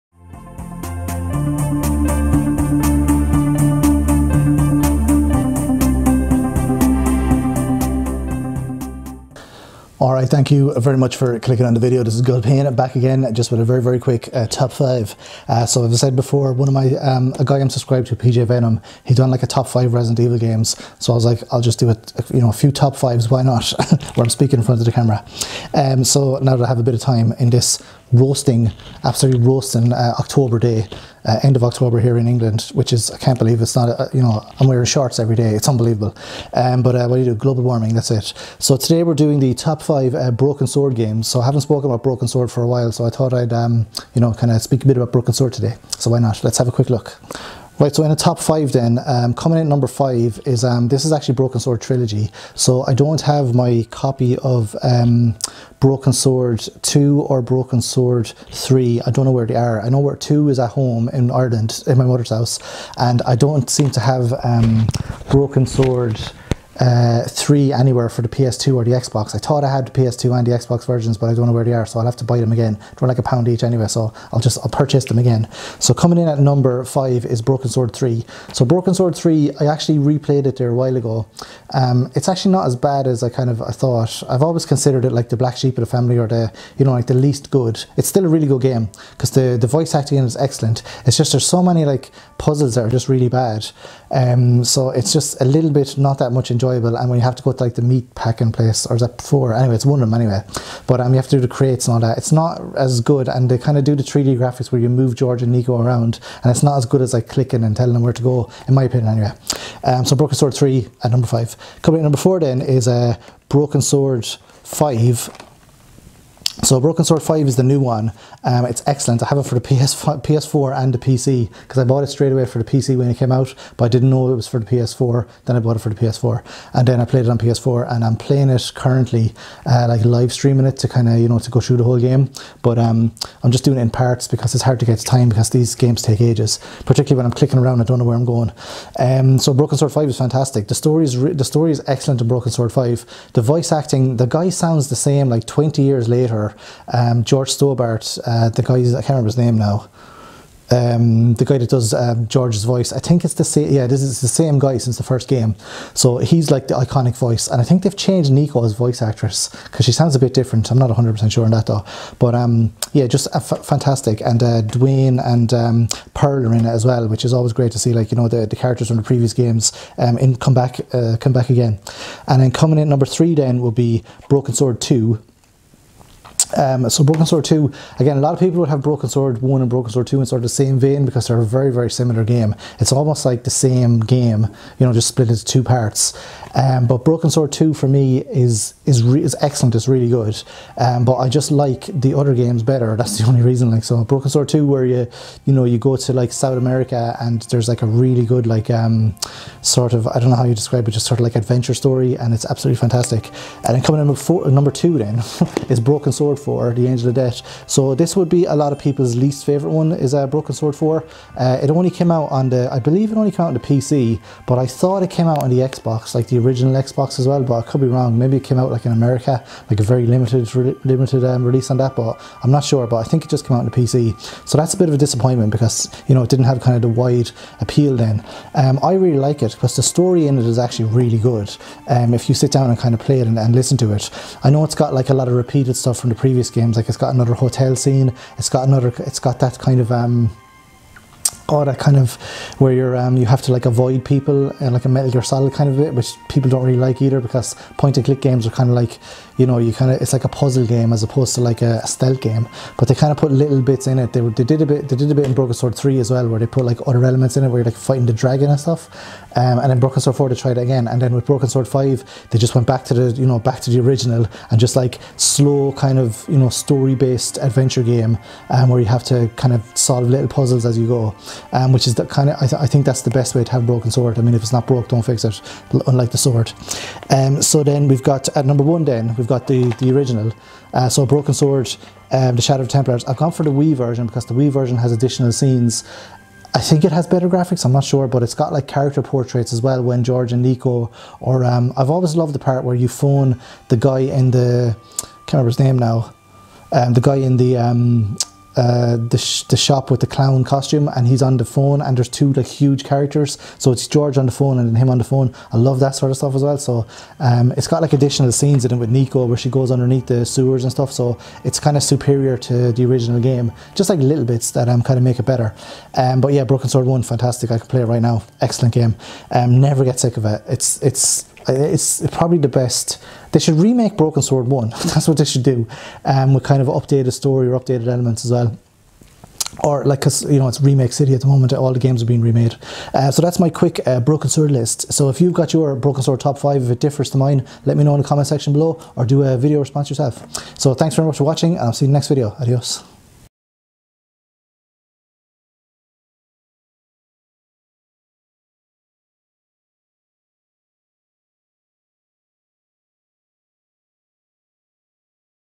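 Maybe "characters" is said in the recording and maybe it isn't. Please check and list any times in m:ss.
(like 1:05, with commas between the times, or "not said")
2:48, 4:48, 5:02.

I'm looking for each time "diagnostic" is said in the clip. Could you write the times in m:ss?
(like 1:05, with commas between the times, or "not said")
not said.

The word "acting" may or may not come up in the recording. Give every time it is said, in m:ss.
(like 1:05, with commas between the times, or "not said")
1:29, 2:23.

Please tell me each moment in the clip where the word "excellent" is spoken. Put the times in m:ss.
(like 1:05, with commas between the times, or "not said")
1:30, 1:58, 2:21, 3:09, 5:18.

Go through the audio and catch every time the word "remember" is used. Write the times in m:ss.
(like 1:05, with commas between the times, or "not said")
2:29, 4:55.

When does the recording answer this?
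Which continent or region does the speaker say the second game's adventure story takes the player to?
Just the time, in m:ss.
3:16.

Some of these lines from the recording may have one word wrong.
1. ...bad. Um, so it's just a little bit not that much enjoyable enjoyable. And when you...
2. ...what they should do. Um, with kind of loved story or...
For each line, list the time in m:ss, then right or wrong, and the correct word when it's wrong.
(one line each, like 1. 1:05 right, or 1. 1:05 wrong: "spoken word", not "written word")
1. 1:33 right
2. 5:25 wrong: "updated", not "loved".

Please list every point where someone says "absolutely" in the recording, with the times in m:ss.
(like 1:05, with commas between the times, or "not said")
0:29, 3:22.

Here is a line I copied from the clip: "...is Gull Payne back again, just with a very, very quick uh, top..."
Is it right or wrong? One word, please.
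right.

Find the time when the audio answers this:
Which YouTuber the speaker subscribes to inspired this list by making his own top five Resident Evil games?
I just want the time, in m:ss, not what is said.
0:18.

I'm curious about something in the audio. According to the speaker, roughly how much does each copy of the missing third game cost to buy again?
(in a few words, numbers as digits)
a pound.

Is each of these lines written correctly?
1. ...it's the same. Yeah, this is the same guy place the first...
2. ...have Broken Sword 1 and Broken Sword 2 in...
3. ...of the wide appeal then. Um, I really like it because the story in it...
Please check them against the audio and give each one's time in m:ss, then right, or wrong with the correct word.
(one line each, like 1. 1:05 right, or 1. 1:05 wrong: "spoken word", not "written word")
1. 2:33 wrong: "since", not "place"
2. 2:58 right
3. 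3:46 right.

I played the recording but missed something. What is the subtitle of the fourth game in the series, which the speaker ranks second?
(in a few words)
The Angel of Death.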